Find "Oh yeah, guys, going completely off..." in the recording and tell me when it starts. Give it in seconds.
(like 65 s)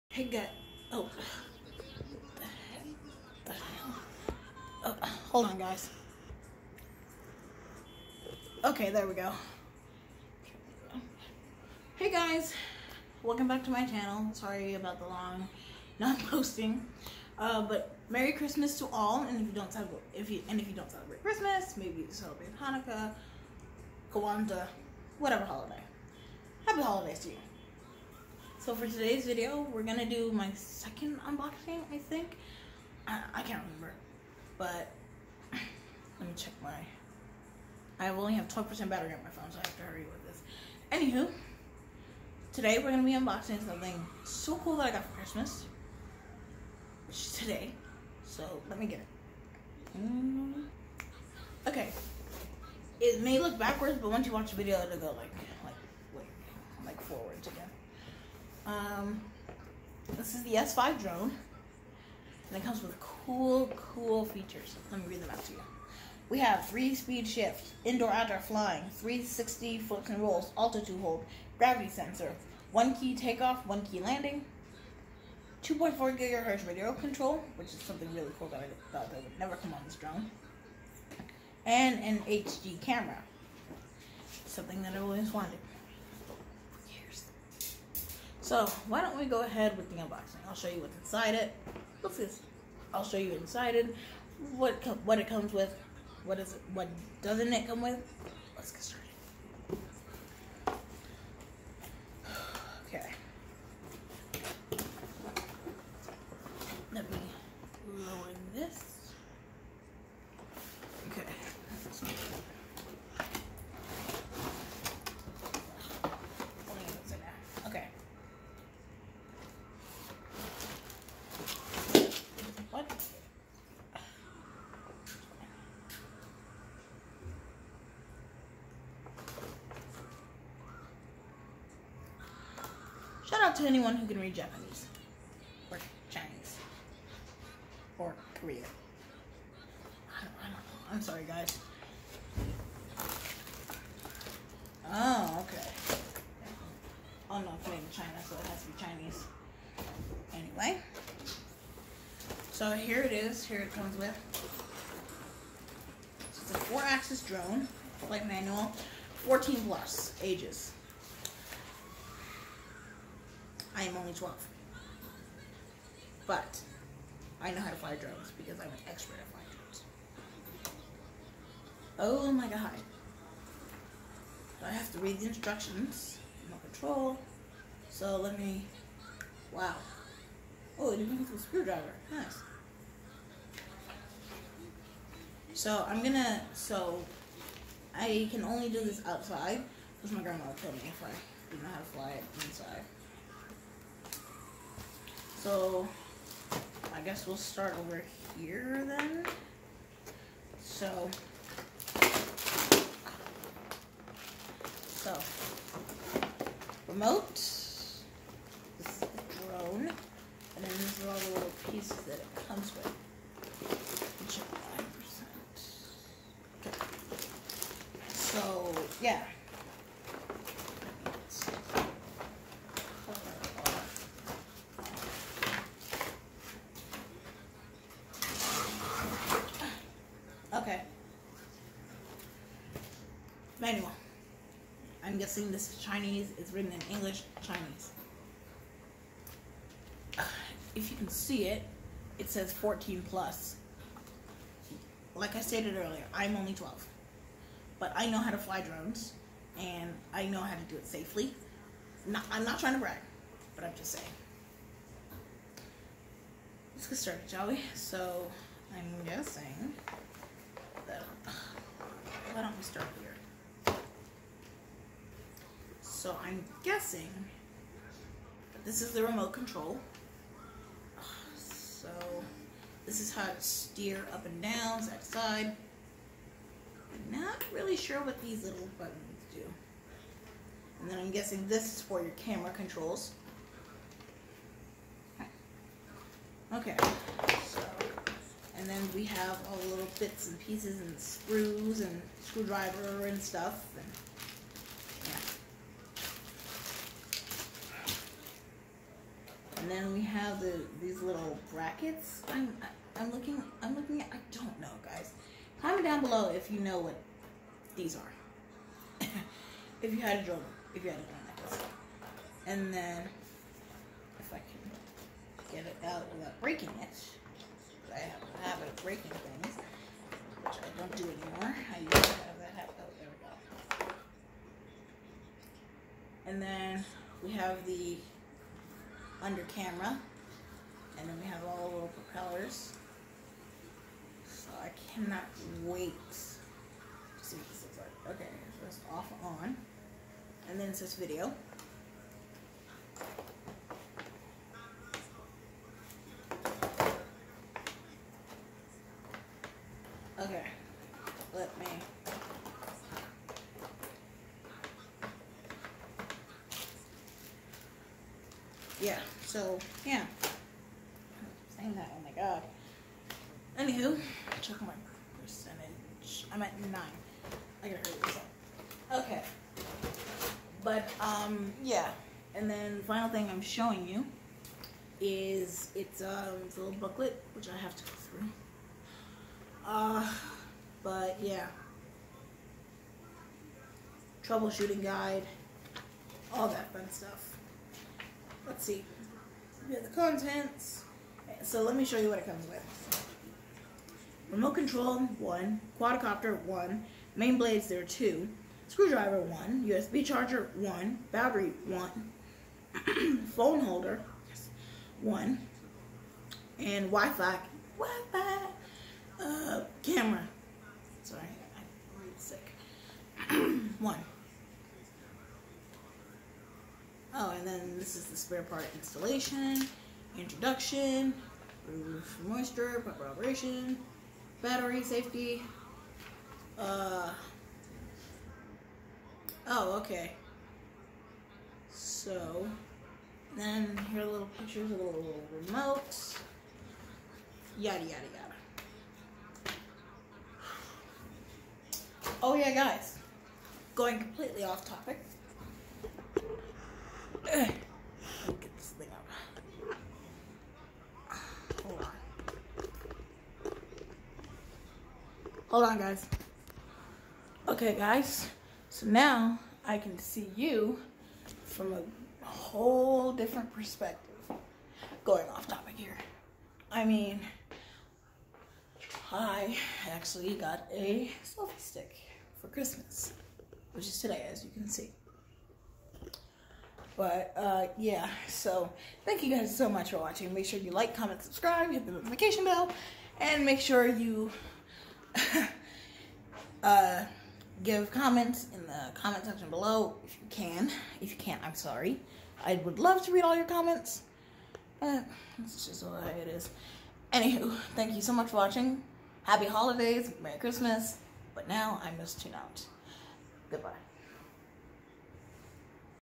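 442 s.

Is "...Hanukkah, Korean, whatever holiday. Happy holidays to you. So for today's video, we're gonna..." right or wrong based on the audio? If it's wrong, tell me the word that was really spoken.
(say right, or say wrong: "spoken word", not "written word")
wrong: "Kwanzaa", not "Korean".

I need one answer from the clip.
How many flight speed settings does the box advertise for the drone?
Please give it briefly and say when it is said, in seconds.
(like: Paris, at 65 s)
three, at 66 s.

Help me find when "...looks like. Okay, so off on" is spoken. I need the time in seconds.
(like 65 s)
337 s.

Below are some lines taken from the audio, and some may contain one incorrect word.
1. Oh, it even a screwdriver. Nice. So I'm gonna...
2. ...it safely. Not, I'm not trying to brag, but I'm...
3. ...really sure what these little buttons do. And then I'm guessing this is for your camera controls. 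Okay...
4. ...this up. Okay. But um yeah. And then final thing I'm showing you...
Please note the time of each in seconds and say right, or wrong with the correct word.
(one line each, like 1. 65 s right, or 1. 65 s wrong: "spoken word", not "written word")
1. 180 s right
2. 250 s right
3. 277 s right
4. 368 s right.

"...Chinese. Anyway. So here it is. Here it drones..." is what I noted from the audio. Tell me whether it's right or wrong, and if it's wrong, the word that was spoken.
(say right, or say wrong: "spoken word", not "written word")
wrong: "comes", not "drones".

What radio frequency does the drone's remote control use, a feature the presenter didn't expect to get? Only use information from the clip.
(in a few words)
2.4 gigahertz.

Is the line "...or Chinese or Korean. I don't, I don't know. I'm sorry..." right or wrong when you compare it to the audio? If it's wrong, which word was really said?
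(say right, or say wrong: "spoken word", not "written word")
right.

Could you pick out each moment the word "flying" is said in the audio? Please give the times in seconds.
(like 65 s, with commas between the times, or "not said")
68 s, 169 s.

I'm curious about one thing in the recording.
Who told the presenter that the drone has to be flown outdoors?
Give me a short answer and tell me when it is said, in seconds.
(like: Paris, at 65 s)
grandma, at 190 s.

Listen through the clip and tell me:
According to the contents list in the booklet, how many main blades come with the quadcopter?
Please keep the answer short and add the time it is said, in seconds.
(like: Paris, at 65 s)
2, at 397 s.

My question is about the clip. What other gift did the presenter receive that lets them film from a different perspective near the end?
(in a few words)
selfie stick.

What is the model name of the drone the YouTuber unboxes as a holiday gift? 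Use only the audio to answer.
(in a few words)
S5.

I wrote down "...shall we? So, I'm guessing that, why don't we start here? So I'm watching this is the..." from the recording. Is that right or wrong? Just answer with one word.
wrong.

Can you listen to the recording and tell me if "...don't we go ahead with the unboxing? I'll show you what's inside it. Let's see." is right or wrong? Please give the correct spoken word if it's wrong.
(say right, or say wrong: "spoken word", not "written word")
right.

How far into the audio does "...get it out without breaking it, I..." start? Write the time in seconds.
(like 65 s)
315 s.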